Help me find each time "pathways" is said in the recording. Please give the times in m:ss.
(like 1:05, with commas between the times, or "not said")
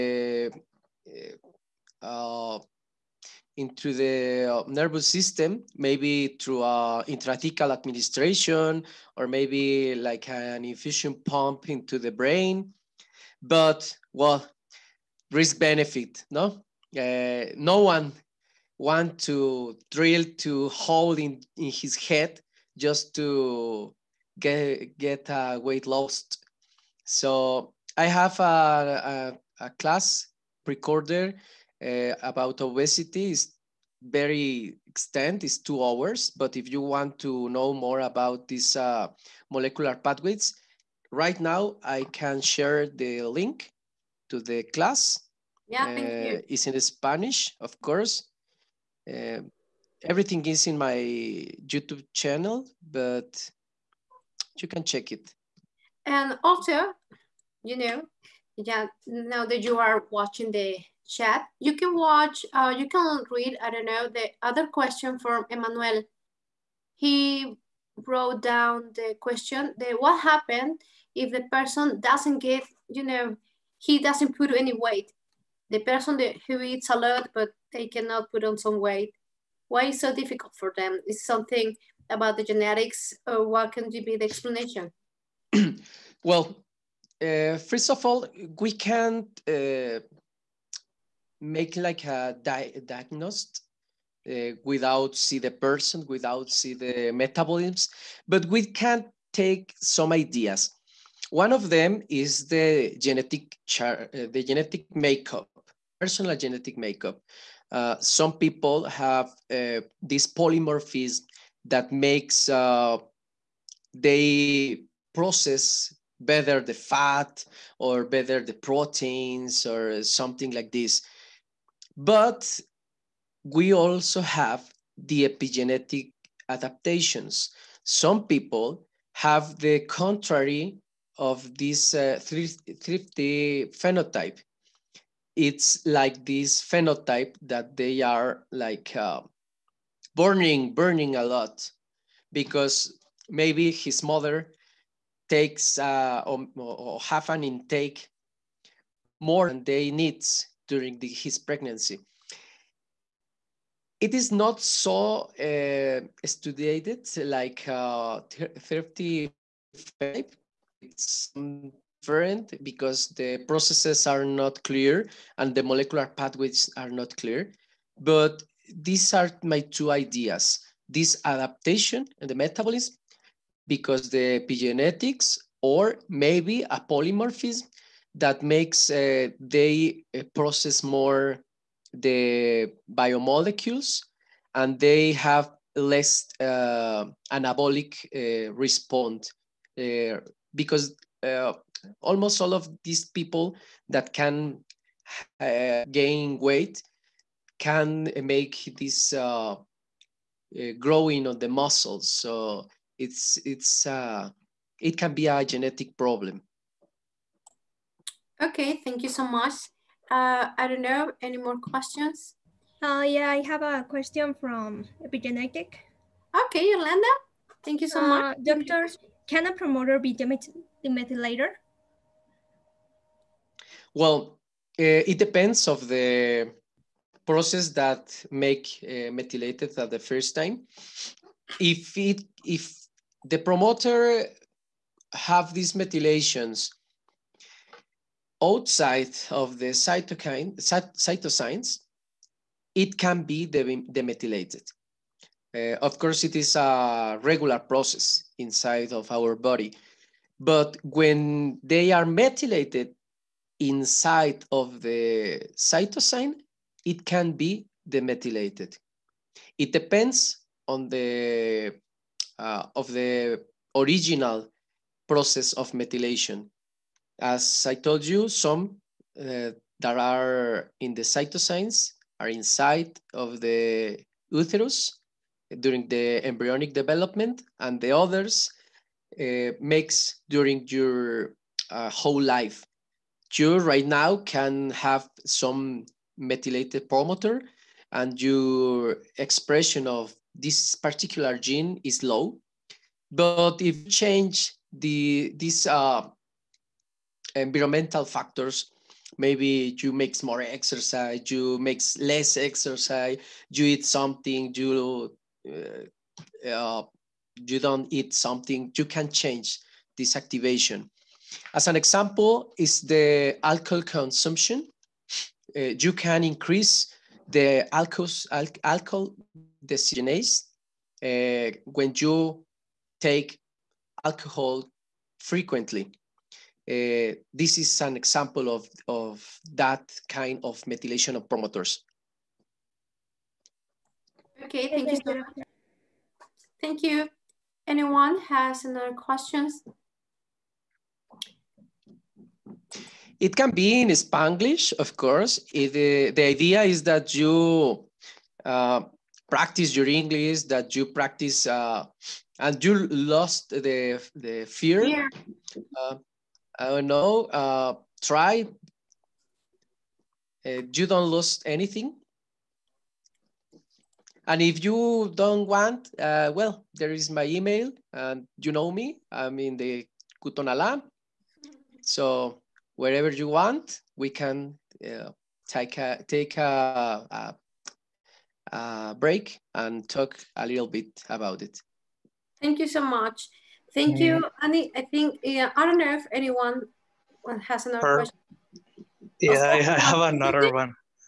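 0:39, 2:46.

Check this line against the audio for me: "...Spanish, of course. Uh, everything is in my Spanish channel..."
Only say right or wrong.
wrong.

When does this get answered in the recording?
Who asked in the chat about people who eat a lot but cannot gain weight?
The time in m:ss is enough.
1:05.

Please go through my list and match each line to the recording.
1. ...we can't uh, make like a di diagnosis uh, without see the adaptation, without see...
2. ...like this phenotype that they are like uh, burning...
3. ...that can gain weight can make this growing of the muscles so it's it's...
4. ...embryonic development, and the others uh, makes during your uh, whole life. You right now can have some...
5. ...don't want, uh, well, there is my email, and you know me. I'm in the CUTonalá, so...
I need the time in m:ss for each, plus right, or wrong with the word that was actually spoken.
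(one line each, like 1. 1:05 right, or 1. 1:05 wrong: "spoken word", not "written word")
1. 1:28 wrong: "person", not "adaptation"
2. 2:15 right
3. 3:13 right
4. 4:36 right
5. 6:05 right.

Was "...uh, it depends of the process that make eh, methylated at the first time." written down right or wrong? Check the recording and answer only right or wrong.
right.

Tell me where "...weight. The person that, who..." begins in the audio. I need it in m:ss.
1:14.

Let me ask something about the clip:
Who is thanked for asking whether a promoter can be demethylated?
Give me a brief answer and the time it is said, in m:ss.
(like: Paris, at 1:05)
Yolanda, at 3:36.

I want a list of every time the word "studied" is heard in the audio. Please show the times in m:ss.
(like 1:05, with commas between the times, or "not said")
2:36.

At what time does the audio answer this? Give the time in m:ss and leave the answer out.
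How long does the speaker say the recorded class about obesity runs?
0:35.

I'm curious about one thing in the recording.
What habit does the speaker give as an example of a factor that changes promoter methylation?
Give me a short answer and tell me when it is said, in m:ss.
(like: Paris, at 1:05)
Alcohol consumption, at 5:13.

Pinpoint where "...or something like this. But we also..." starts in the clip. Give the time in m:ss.
1:59.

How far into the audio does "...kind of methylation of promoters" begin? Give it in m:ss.
5:30.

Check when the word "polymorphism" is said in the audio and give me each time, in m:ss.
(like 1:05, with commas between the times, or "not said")
1:50, 2:56.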